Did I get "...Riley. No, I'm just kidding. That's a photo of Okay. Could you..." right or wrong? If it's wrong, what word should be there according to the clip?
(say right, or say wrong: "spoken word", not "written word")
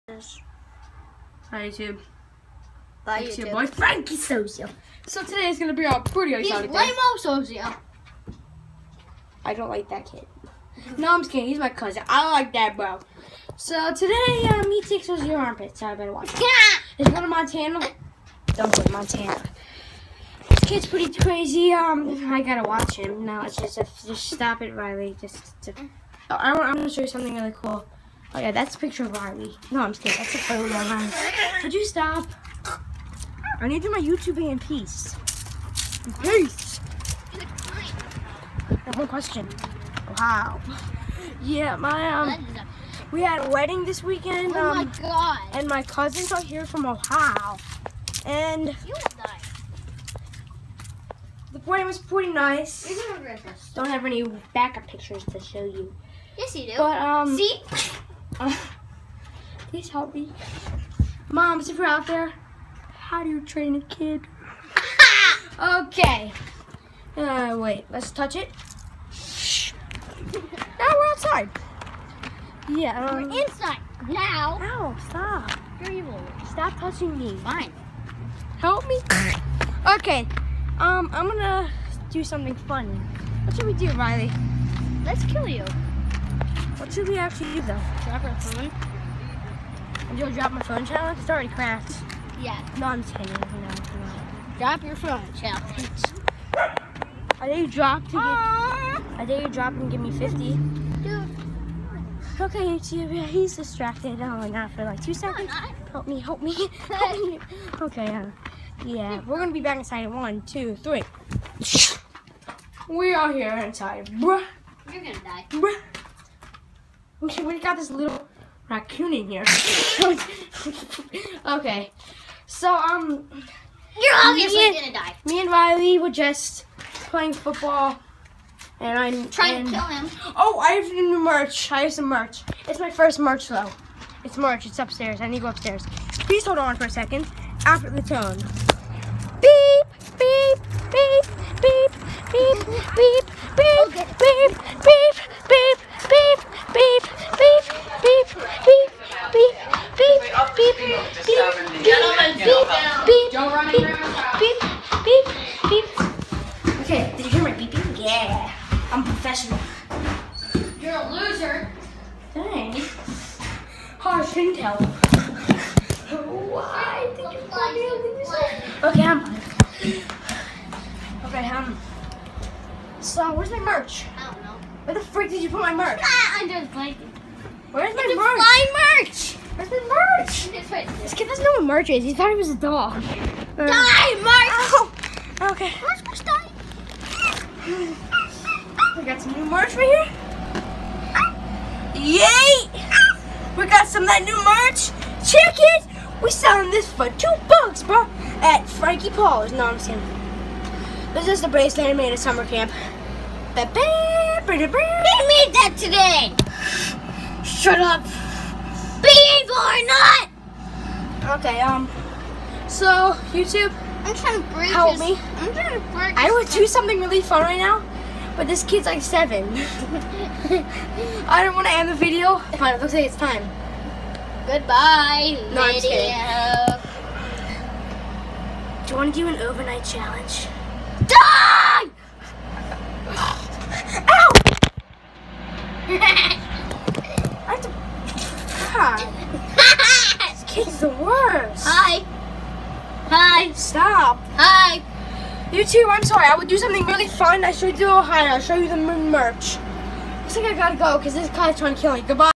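wrong: "Riley", not "Okay".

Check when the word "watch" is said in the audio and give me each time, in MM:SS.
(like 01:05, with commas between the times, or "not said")
00:16, 00:22.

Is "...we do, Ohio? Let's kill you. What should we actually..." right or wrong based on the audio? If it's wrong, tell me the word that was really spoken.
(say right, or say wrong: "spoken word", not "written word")
wrong: "Riley", not "Ohio".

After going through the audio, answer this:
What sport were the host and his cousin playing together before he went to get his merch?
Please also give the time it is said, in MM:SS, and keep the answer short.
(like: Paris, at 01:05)
football, at 02:07.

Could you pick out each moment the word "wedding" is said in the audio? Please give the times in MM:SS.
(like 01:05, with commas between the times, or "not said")
00:43, 00:51.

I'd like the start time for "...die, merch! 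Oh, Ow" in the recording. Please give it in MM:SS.
03:03.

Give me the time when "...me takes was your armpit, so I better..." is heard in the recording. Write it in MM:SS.
00:14.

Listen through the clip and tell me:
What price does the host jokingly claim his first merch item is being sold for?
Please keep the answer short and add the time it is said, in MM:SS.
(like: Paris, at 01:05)
2 bucks, at 03:17.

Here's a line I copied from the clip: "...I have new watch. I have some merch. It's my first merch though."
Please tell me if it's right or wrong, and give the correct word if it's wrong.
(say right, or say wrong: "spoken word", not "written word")
wrong: "merch", not "watch".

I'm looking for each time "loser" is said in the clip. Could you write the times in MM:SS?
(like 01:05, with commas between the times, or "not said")
02:41.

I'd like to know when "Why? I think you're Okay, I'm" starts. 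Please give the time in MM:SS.
02:46.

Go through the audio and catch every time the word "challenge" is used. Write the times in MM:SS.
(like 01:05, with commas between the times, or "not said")
01:30, 01:35, 03:49.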